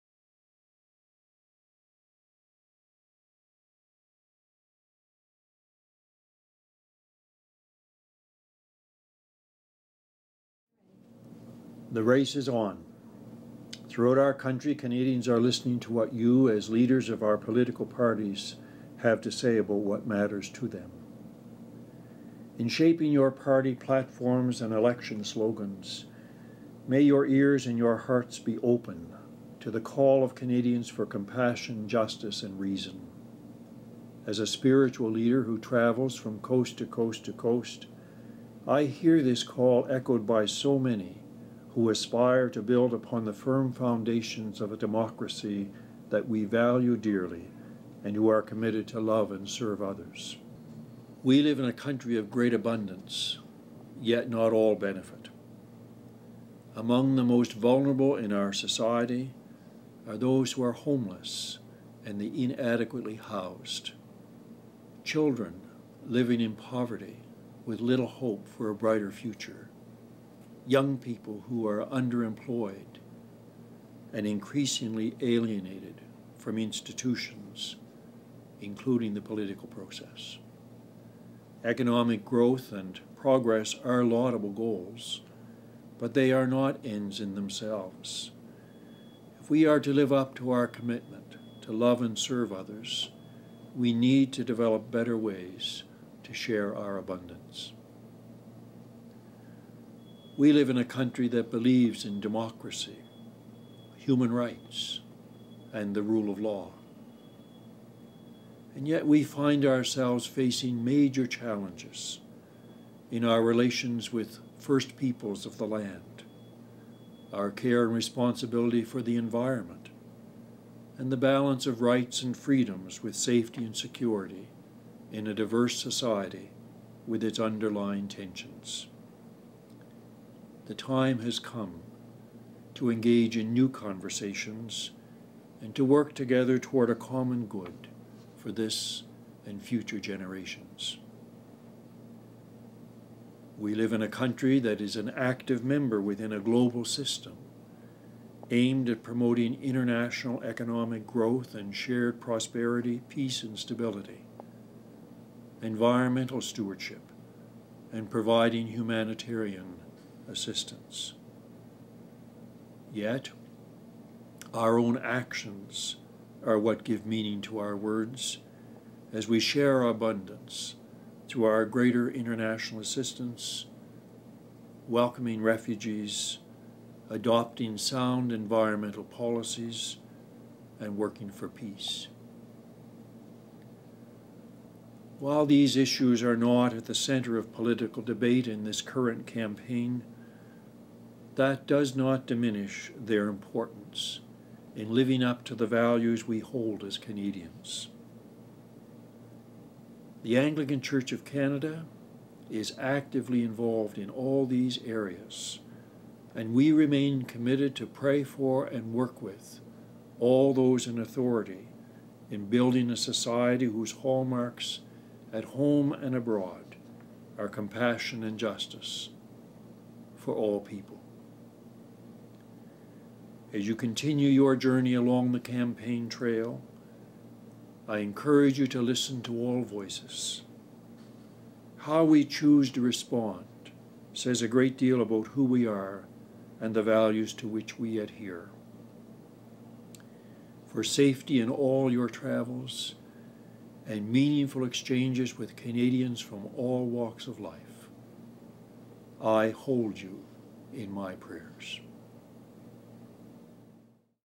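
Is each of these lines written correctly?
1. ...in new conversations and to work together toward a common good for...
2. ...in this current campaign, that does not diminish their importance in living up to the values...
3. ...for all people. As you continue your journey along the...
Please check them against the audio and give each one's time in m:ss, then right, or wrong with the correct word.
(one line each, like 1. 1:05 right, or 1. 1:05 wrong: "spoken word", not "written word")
1. 2:13 right
2. 3:08 right
3. 3:40 right.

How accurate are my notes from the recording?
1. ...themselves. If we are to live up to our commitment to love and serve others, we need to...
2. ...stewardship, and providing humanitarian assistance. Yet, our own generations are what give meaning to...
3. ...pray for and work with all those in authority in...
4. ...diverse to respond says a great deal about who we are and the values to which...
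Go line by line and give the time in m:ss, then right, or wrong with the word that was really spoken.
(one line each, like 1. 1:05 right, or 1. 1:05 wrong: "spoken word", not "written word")
1. 1:27 right
2. 2:36 wrong: "actions", not "generations"
3. 3:27 right
4. 3:52 wrong: "choose", not "diverse".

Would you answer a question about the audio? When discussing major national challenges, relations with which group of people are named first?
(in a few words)
first peoples of the land.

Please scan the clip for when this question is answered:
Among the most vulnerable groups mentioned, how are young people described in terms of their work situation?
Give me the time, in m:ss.
1:11.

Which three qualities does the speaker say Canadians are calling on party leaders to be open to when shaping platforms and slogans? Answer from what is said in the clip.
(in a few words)
compassion, justice, and reason.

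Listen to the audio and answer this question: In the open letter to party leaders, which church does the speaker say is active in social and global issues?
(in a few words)
Anglican Church of Canada.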